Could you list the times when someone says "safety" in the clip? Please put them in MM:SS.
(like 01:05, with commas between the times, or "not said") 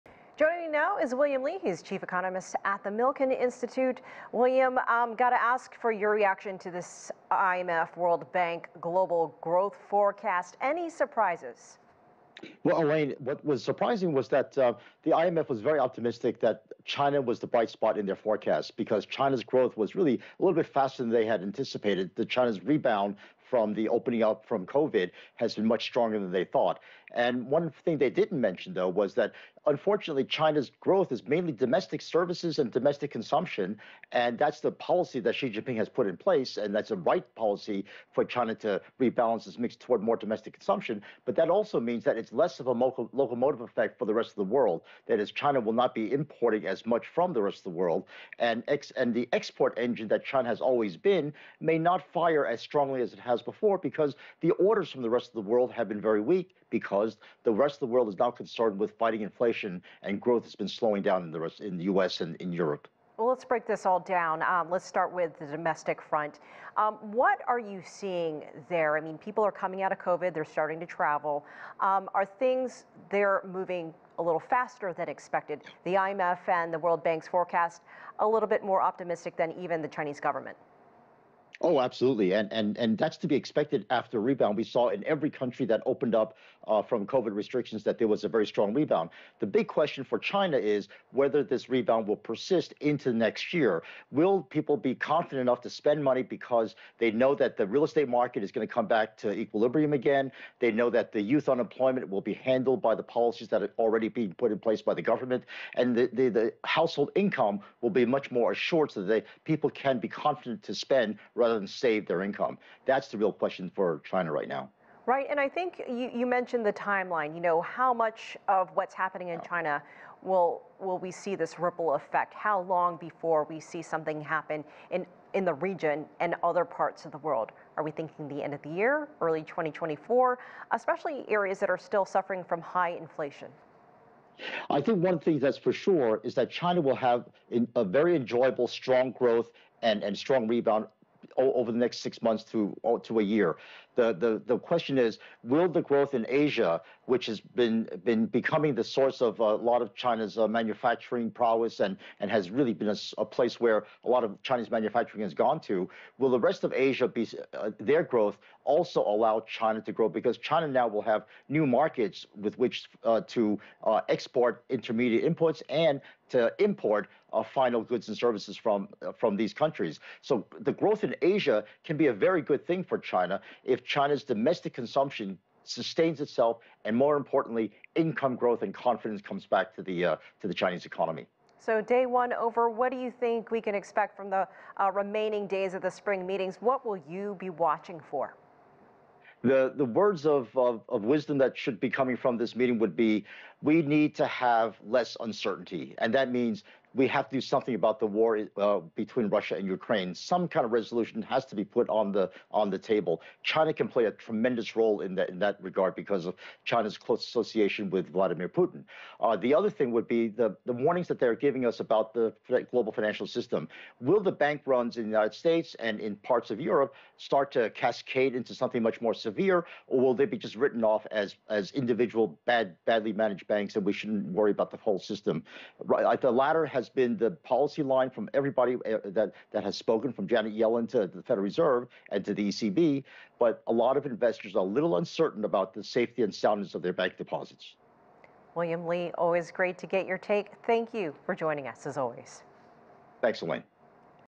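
03:55.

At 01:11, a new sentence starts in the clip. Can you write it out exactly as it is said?
Um, are things there moving a little faster than expected?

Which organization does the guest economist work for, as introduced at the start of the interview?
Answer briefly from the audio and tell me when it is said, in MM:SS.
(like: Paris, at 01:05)
Milken Institute, at 00:02.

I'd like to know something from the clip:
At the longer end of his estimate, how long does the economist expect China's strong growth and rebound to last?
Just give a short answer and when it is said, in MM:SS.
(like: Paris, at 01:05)
a year, at 02:22.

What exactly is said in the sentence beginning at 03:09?
The, the words of, of, of wisdom that should be coming from this meeting would be we need to have less uncertainty.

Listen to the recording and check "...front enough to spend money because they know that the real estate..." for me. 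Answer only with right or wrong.
wrong.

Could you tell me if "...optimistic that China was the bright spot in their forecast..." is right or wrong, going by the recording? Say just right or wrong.
right.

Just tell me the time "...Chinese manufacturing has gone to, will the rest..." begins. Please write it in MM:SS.
02:34.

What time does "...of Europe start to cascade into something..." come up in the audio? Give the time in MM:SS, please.
03:36.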